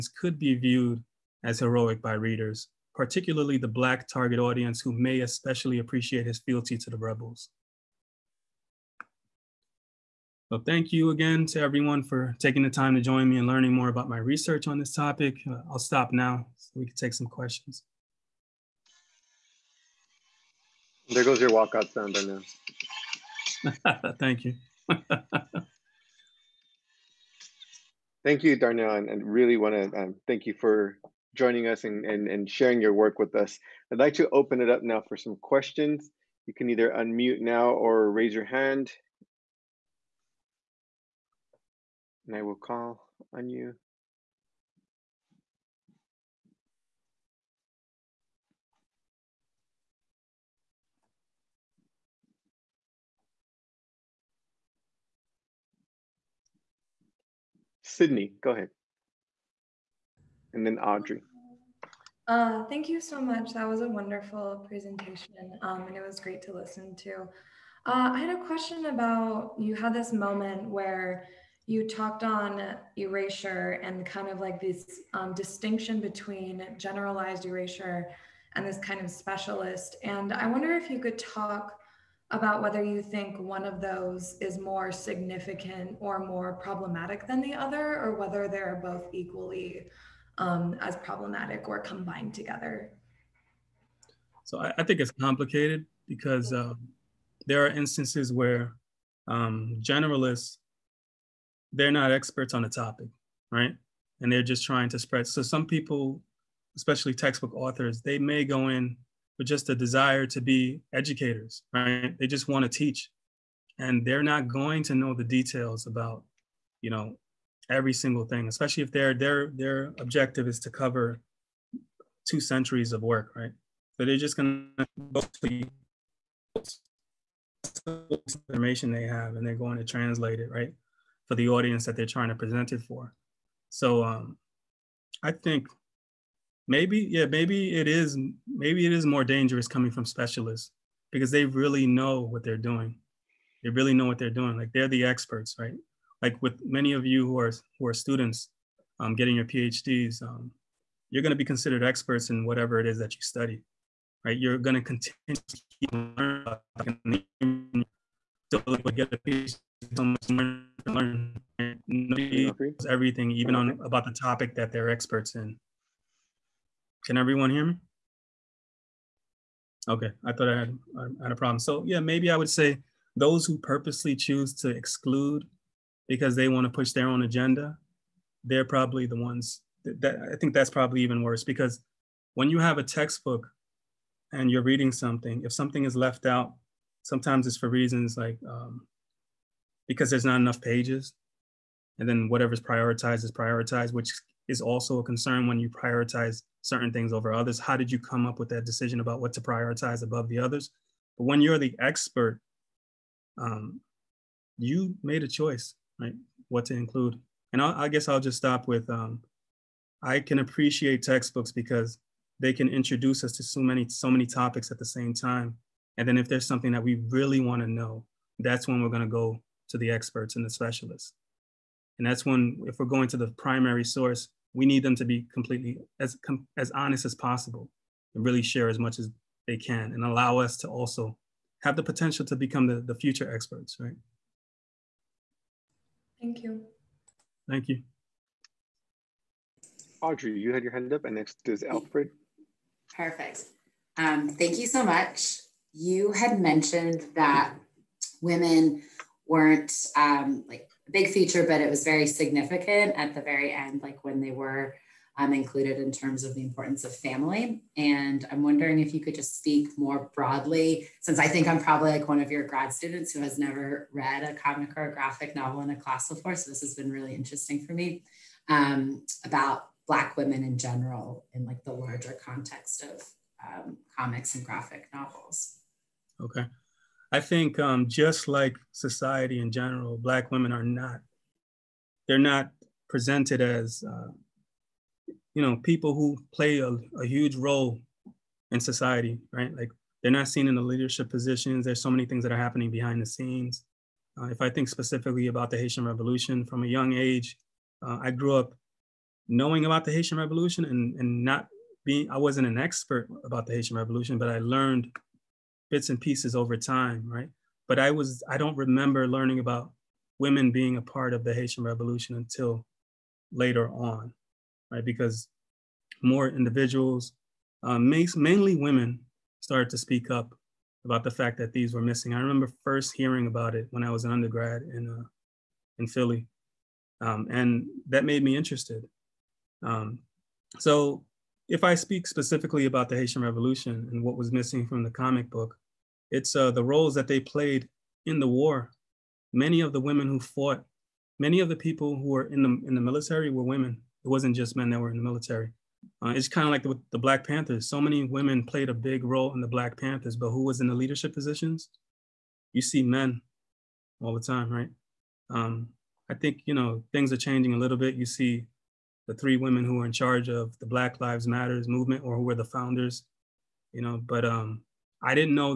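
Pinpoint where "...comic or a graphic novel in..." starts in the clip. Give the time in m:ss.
4:24.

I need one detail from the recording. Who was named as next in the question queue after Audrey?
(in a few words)
Alfred.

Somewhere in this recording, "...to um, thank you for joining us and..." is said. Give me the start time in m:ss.
0:29.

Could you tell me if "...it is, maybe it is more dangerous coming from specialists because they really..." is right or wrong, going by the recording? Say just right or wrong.
right.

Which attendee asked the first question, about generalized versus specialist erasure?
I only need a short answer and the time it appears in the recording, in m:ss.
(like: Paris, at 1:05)
Sydney, at 0:57.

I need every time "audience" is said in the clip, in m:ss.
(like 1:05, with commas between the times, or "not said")
0:04, 2:11.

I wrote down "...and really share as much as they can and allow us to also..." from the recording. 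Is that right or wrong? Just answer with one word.
right.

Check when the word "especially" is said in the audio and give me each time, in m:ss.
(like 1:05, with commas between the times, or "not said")
0:05, 1:46, 1:58.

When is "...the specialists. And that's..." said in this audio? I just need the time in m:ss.
3:40.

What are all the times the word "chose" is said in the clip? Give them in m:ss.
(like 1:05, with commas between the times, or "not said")
not said.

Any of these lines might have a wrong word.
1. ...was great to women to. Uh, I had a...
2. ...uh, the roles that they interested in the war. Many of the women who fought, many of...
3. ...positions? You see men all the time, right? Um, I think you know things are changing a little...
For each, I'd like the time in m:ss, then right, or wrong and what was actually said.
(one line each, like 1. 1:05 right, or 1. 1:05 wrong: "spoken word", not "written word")
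1. 1:06 wrong: "listen", not "women"
2. 5:36 wrong: "played", not "interested"
3. 5:51 right.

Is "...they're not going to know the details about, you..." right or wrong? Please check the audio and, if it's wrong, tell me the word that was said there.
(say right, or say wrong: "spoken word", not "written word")
right.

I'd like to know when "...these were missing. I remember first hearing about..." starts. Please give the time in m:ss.
5:21.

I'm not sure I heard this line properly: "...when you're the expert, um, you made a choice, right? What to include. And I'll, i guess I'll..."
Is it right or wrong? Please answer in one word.
right.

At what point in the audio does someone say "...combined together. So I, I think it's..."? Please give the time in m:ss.
1:31.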